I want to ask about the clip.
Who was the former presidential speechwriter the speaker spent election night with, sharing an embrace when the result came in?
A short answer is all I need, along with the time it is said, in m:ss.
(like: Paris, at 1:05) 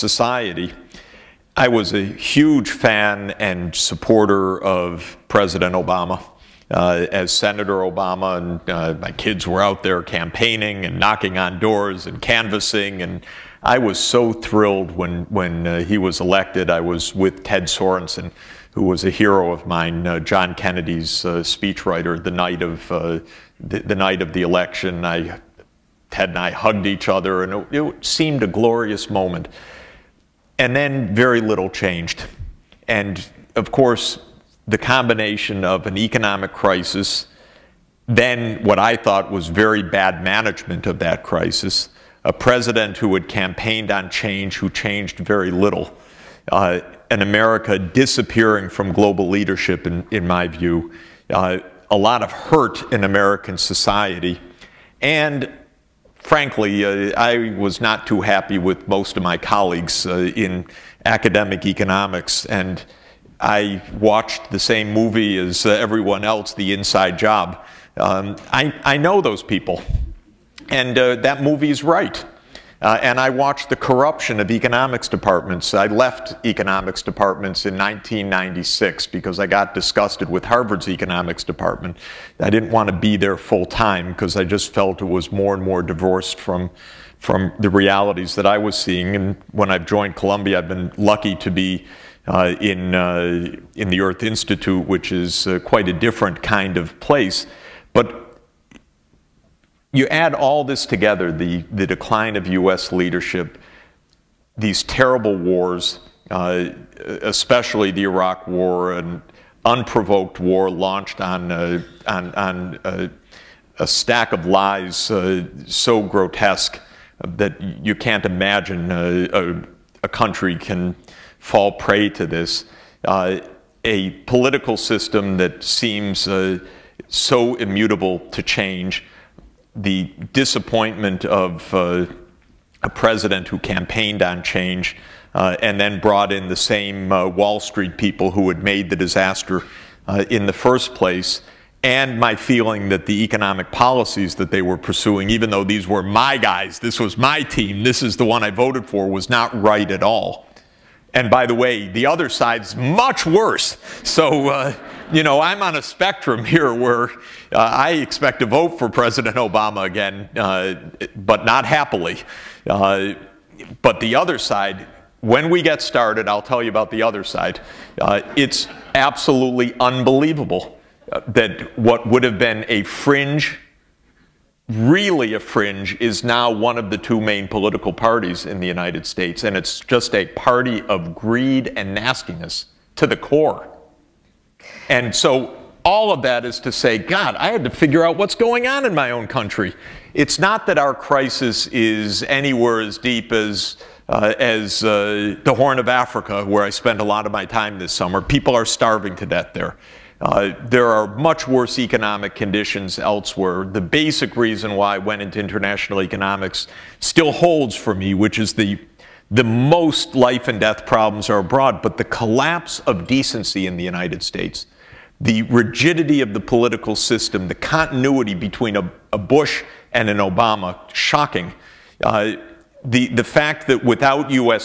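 Ted Sorensen, at 0:17.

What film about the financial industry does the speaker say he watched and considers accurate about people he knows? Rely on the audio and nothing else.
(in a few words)
The Inside Job.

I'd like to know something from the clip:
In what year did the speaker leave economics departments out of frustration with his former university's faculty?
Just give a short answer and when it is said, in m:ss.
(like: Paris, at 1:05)
1996, at 1:17.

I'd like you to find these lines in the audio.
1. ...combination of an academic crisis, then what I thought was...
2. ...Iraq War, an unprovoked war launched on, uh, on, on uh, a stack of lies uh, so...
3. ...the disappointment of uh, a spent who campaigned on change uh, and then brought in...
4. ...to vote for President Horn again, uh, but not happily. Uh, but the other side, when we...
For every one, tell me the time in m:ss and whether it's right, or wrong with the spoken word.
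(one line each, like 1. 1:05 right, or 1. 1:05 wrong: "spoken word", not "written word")
1. 0:34 wrong: "economic", not "academic"
2. 1:48 right
3. 2:09 wrong: "president", not "spent"
4. 2:38 wrong: "Obama", not "Horn".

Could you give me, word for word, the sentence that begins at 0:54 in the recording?
And frankly, uh, I was not too happy with most of my colleagues uh, in academic economics.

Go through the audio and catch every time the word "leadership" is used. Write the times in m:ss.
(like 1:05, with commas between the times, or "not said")
0:49, 1:42.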